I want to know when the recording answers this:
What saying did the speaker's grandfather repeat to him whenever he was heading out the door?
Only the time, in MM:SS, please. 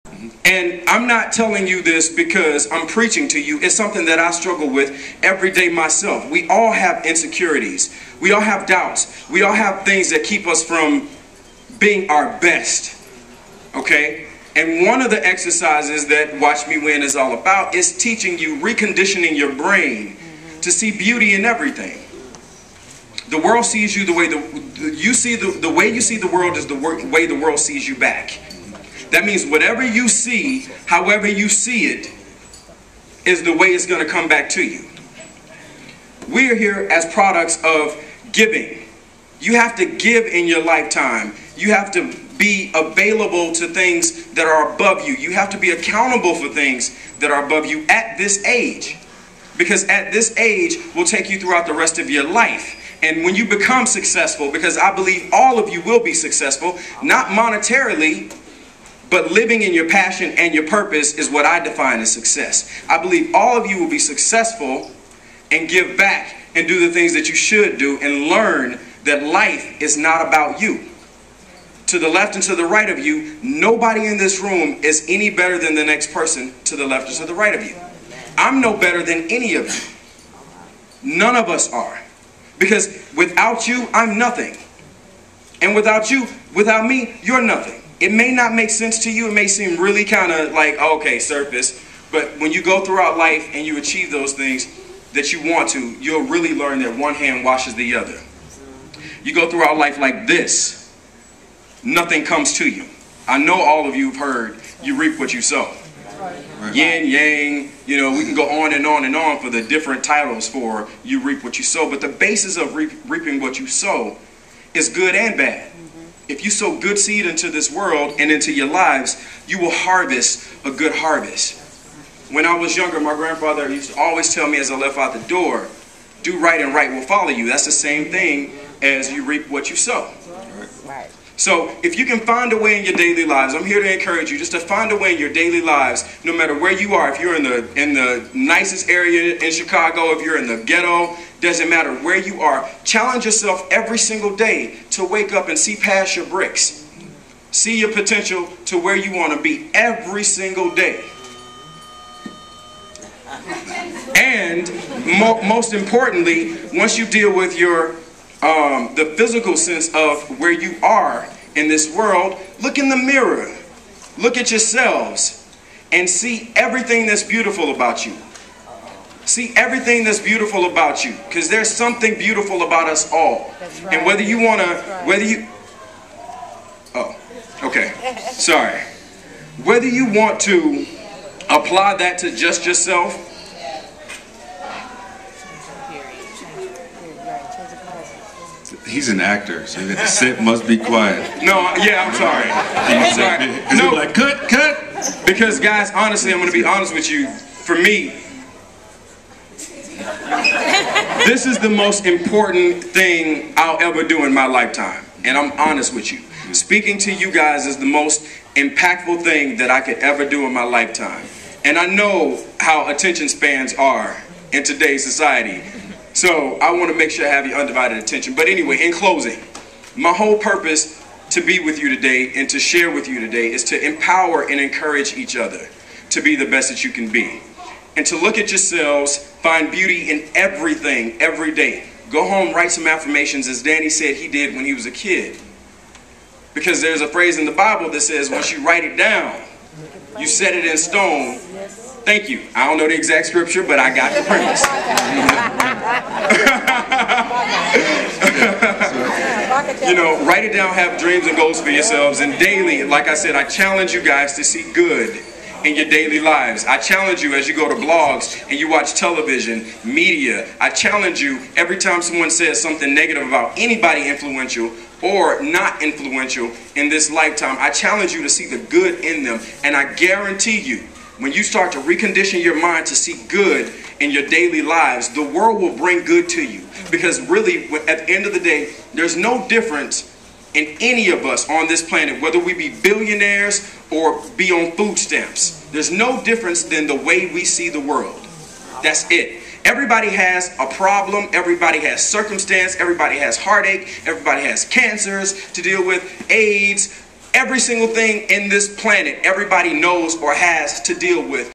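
02:06.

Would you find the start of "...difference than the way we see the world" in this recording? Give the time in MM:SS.
04:46.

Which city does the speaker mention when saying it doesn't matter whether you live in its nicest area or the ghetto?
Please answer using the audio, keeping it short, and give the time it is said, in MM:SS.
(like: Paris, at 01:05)
Chicago, at 02:19.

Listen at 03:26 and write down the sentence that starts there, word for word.
Speaking to you guys is the most impactful thing that I could ever do in my lifetime.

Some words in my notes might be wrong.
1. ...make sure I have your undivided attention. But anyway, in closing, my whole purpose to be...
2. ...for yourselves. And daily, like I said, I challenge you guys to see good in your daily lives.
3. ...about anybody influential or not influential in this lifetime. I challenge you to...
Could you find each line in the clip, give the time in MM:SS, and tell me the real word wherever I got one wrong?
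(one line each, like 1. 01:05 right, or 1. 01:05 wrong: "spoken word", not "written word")
1. 03:36 right
2. 04:11 right
3. 04:23 right.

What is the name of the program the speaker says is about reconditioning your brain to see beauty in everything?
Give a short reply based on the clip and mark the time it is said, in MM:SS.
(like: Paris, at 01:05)
Watch Me Win, at 00:16.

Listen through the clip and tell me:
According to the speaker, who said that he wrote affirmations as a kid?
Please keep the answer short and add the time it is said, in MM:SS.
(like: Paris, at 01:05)
Danny, at 03:53.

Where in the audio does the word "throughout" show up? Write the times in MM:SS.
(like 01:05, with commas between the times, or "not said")
00:51, 01:32, 01:39.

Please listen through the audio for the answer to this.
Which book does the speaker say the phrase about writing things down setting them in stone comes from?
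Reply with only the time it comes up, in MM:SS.
03:57.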